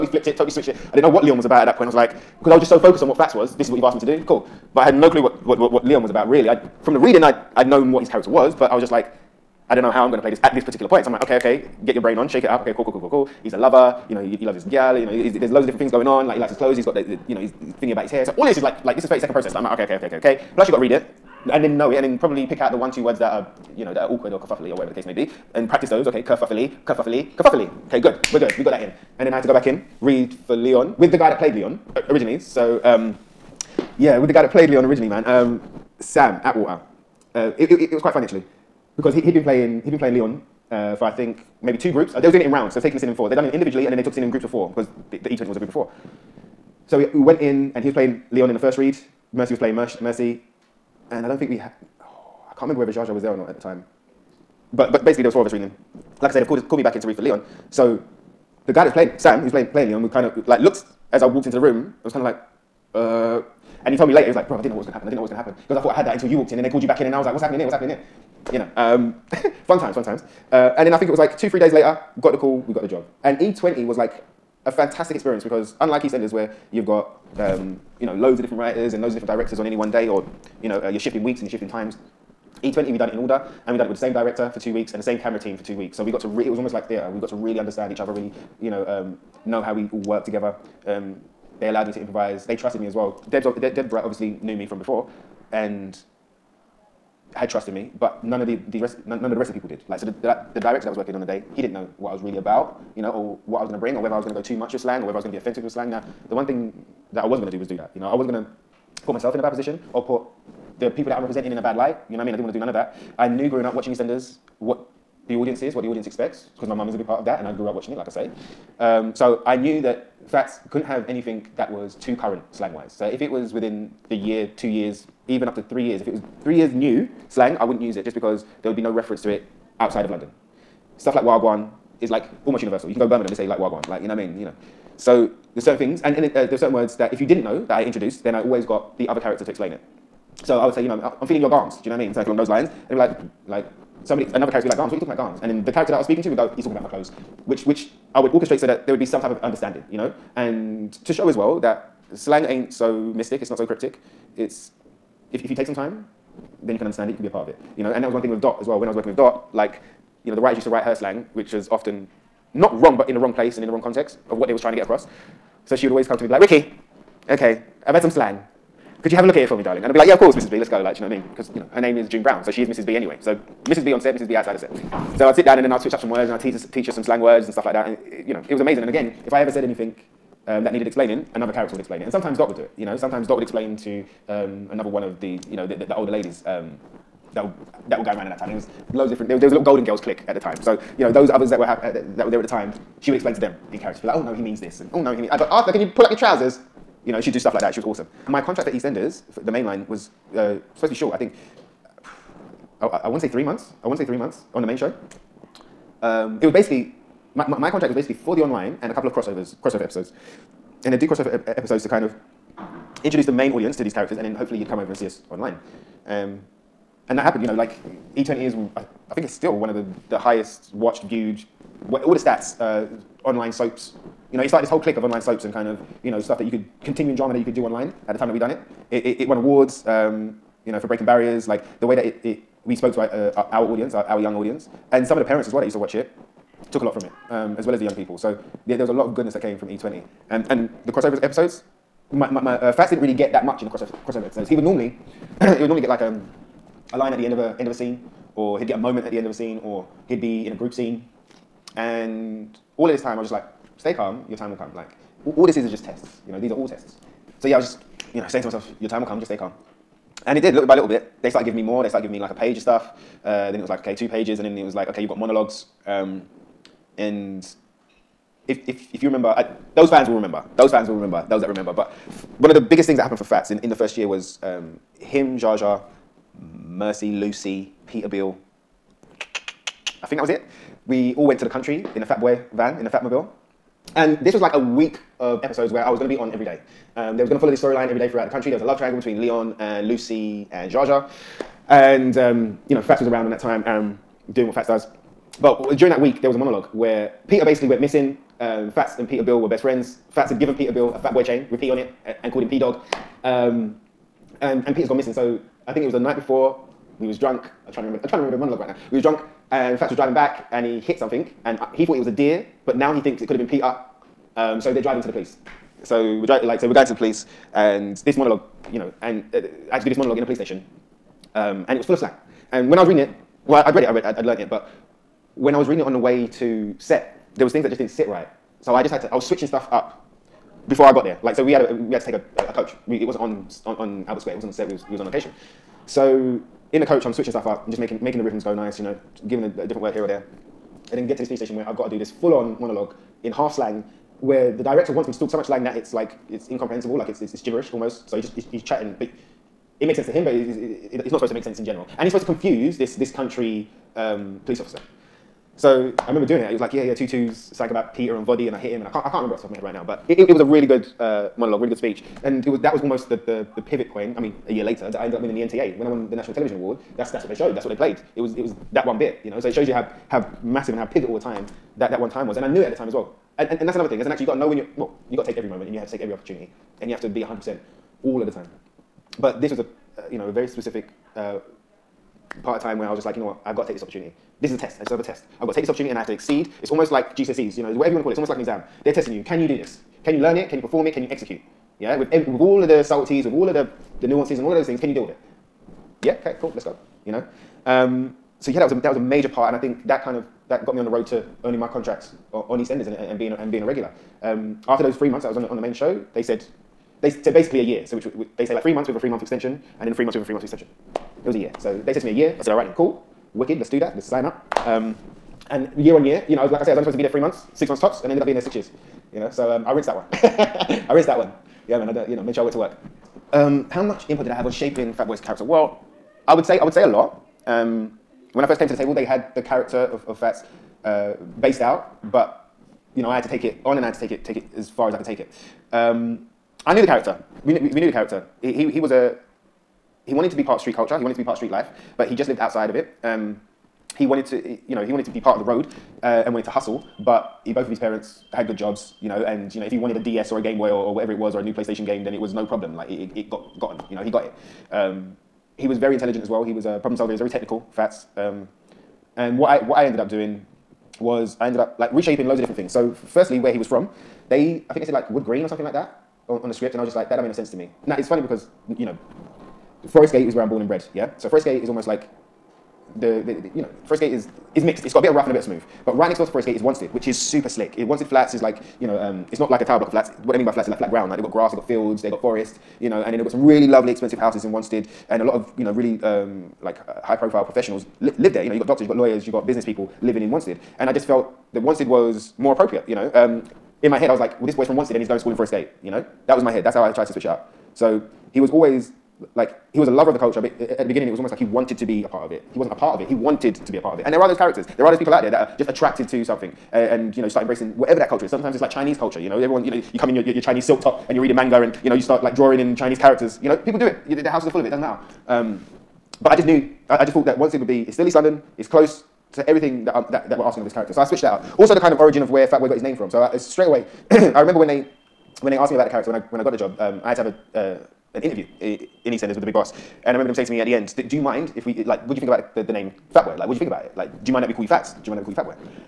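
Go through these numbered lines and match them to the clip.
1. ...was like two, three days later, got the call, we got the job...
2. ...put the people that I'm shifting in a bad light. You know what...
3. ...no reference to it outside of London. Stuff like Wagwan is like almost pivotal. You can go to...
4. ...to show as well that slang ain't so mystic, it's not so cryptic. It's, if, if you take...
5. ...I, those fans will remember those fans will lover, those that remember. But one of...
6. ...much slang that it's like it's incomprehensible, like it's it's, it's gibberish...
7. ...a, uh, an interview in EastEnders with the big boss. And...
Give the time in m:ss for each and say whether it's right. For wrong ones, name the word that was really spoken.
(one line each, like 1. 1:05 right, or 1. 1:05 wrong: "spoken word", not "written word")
1. 1:11 right
2. 1:50 wrong: "representing", not "shifting"
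3. 2:08 wrong: "universal", not "pivotal"
4. 2:31 right
5. 4:29 wrong: "remember", not "lover"
6. 5:45 right
7. 8:47 right.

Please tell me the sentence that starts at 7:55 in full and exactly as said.
But right next door to Forest Gate is Wanstead, which is super slick.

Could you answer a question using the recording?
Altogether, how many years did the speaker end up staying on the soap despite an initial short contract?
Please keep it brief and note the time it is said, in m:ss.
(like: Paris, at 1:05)
6, at 6:58.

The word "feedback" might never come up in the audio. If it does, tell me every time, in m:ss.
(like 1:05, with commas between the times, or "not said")
not said.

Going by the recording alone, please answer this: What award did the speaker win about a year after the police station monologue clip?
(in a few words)
National Television Award.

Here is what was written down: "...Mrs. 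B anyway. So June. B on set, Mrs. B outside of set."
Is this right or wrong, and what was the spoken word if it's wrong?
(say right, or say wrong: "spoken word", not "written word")
wrong: "Mrs", not "June".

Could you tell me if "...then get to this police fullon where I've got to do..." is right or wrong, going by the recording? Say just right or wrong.
wrong.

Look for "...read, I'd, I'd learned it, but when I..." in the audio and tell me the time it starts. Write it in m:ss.
5:23.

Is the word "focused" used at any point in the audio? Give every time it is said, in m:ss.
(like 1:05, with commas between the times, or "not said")
0:02.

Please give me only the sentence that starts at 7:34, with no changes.
Um, he was very intelligent as well.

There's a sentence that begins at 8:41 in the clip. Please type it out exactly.
Also, the kind of origin of where Fatboy got his name from.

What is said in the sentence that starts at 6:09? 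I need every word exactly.
So it shows you how how massive and how pivotal a time that, that one time was.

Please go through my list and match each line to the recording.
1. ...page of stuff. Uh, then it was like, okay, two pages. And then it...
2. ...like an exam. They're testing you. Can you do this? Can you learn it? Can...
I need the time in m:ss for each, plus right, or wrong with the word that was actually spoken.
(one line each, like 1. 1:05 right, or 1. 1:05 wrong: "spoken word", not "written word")
1. 4:22 right
2. 6:28 right.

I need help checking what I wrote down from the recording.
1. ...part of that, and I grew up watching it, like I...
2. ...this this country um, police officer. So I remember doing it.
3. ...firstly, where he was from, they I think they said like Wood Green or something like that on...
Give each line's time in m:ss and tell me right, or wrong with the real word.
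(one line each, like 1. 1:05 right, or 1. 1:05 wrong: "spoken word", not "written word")
1. 1:57 right
2. 5:52 right
3. 7:43 right.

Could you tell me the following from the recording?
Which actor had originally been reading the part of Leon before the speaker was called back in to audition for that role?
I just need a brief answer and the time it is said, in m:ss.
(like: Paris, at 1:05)
Sam Attwater, at 0:36.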